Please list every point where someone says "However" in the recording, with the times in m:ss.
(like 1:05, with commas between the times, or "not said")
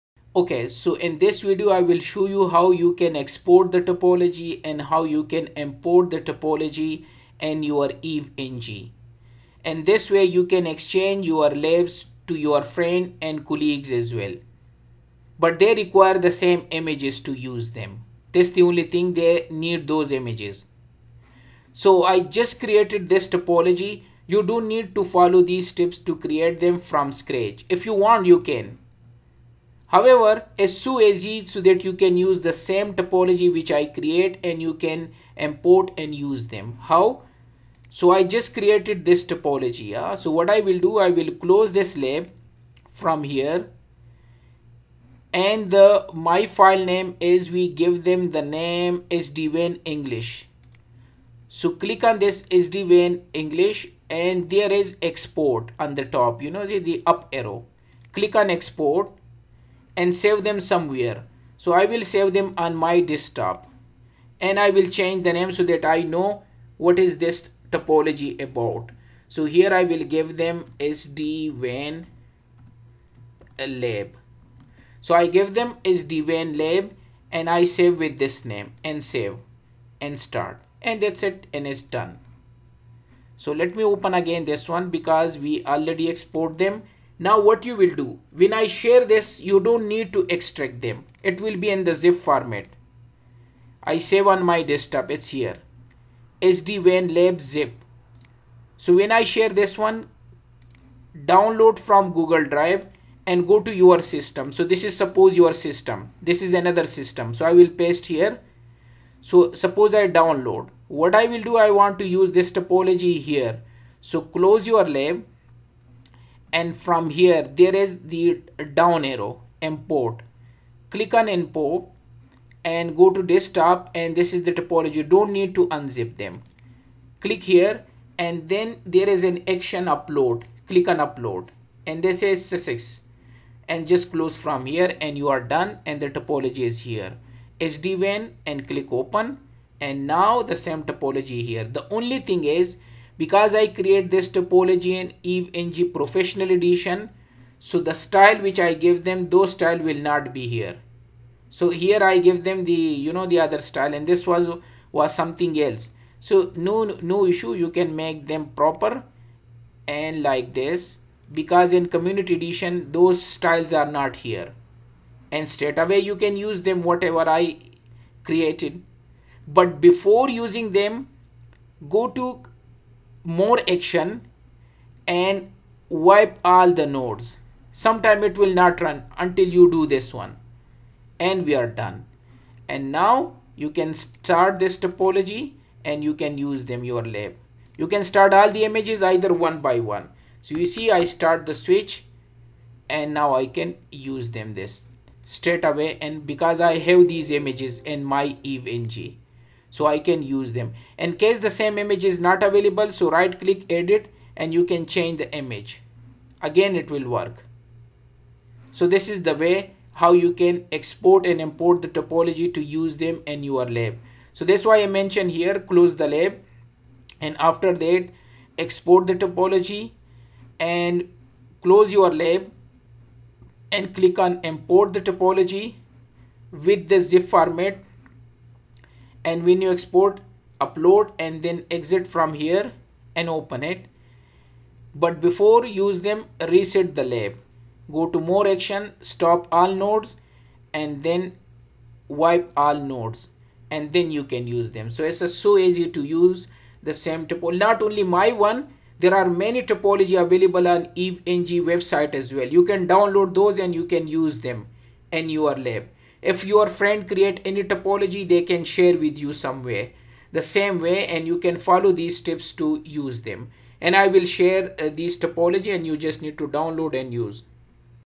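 0:29.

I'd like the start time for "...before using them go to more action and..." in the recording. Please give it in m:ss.
2:49.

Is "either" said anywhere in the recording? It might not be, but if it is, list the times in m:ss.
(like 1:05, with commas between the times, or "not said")
3:09.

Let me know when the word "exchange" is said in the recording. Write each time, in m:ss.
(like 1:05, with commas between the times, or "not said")
0:10.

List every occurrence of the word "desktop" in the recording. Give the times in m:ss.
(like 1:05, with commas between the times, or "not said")
1:03, 1:34, 2:03.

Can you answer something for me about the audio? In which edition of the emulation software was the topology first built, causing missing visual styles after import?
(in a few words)
professional edition.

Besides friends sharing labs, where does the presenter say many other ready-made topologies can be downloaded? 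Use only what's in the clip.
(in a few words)
EVE-NG website.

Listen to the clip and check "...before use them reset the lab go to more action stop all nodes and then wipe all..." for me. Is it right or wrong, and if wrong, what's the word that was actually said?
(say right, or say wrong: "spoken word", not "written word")
right.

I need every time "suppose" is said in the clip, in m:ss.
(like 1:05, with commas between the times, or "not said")
1:44, 1:49.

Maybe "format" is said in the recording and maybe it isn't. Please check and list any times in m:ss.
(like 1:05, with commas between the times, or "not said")
1:32, 3:47.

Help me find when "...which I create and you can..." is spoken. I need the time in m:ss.
0:33.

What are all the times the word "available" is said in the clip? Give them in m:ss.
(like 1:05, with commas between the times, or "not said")
3:22, 4:10.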